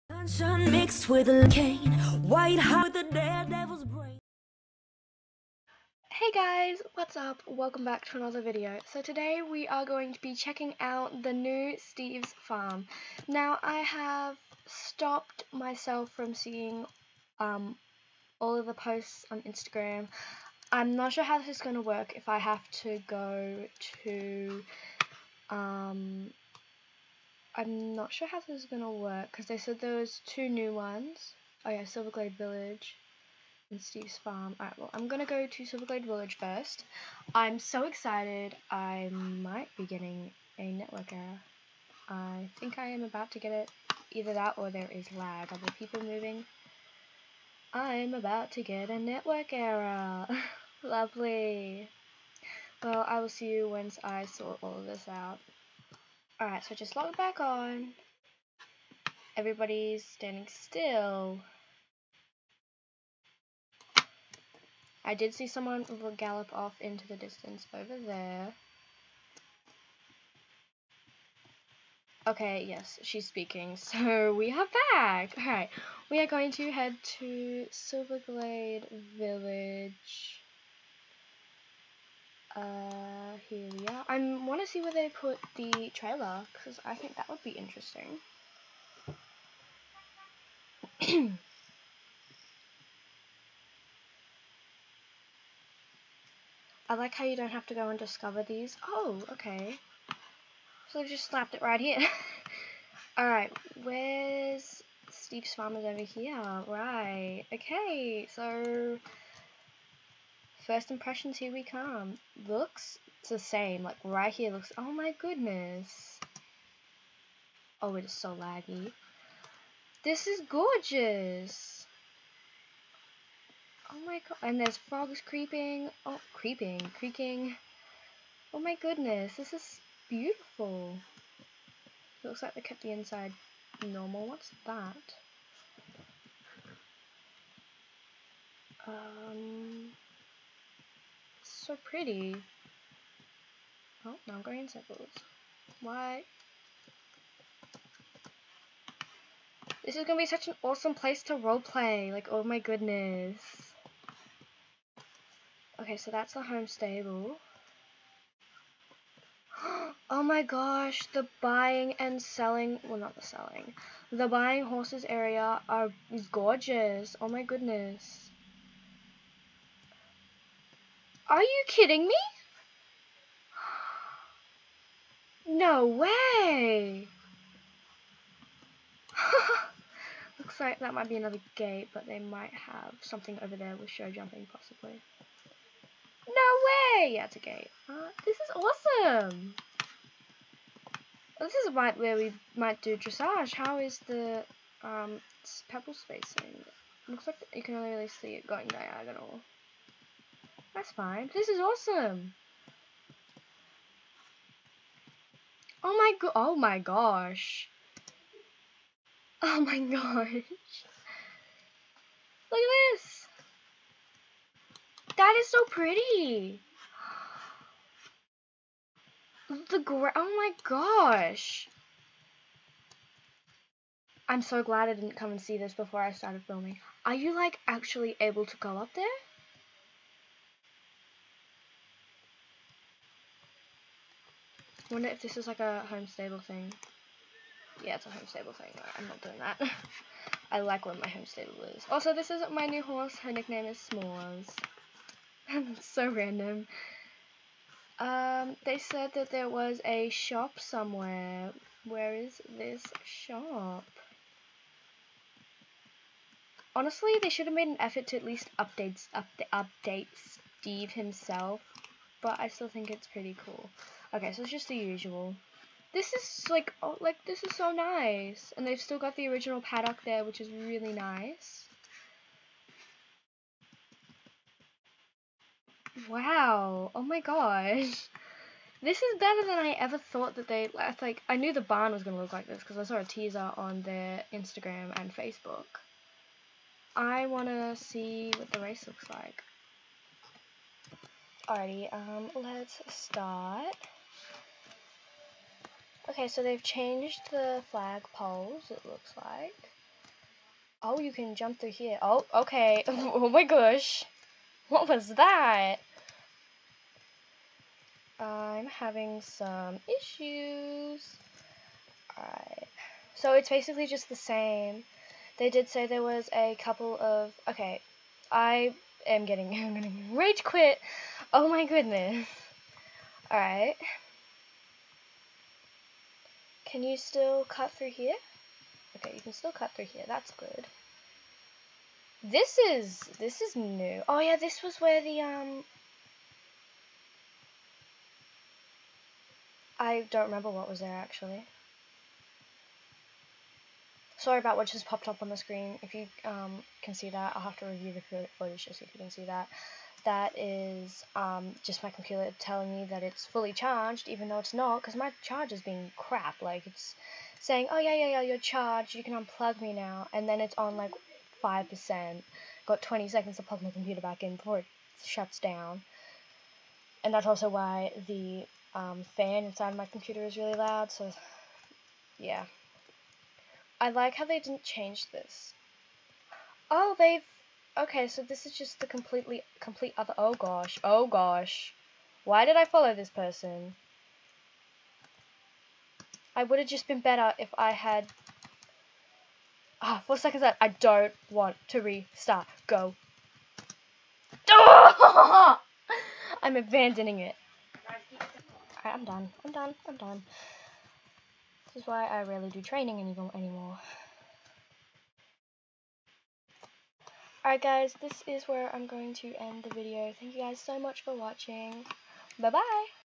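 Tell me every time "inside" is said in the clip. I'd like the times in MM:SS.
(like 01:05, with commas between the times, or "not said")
02:12, 06:09.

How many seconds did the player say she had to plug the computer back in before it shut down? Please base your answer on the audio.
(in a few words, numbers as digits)
20.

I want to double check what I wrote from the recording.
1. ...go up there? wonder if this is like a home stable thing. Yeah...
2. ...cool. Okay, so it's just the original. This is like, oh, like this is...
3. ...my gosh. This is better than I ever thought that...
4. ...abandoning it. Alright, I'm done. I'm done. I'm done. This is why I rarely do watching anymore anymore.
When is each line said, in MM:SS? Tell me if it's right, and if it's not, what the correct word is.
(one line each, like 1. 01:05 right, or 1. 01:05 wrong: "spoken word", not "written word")
1. 03:48 right
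2. 04:23 wrong: "usual", not "original"
3. 04:37 right
4. 06:36 wrong: "training", not "watching".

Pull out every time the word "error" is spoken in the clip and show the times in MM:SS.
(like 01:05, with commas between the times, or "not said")
00:41, 00:49.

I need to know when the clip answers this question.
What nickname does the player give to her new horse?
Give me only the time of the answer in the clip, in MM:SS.
04:03.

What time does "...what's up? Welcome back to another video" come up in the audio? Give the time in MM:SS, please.
00:06.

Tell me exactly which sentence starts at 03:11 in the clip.
This is right where we might do dressage.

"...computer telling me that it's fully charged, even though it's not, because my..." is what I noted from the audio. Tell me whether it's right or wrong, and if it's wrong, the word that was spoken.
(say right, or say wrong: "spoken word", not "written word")
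right.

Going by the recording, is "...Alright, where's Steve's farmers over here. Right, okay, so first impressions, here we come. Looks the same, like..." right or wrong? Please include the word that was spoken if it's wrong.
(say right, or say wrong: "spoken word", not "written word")
right.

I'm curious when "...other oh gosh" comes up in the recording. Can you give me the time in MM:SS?
06:19.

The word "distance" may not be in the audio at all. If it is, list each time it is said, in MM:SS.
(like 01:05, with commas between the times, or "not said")
01:07.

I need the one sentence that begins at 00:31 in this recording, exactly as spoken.
Oh yeah, Silverglade Village and Steve's Farm.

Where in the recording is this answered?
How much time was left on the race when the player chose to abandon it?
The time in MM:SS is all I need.
06:30.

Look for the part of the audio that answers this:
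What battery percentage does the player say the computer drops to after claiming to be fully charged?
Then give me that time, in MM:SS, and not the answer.
06:01.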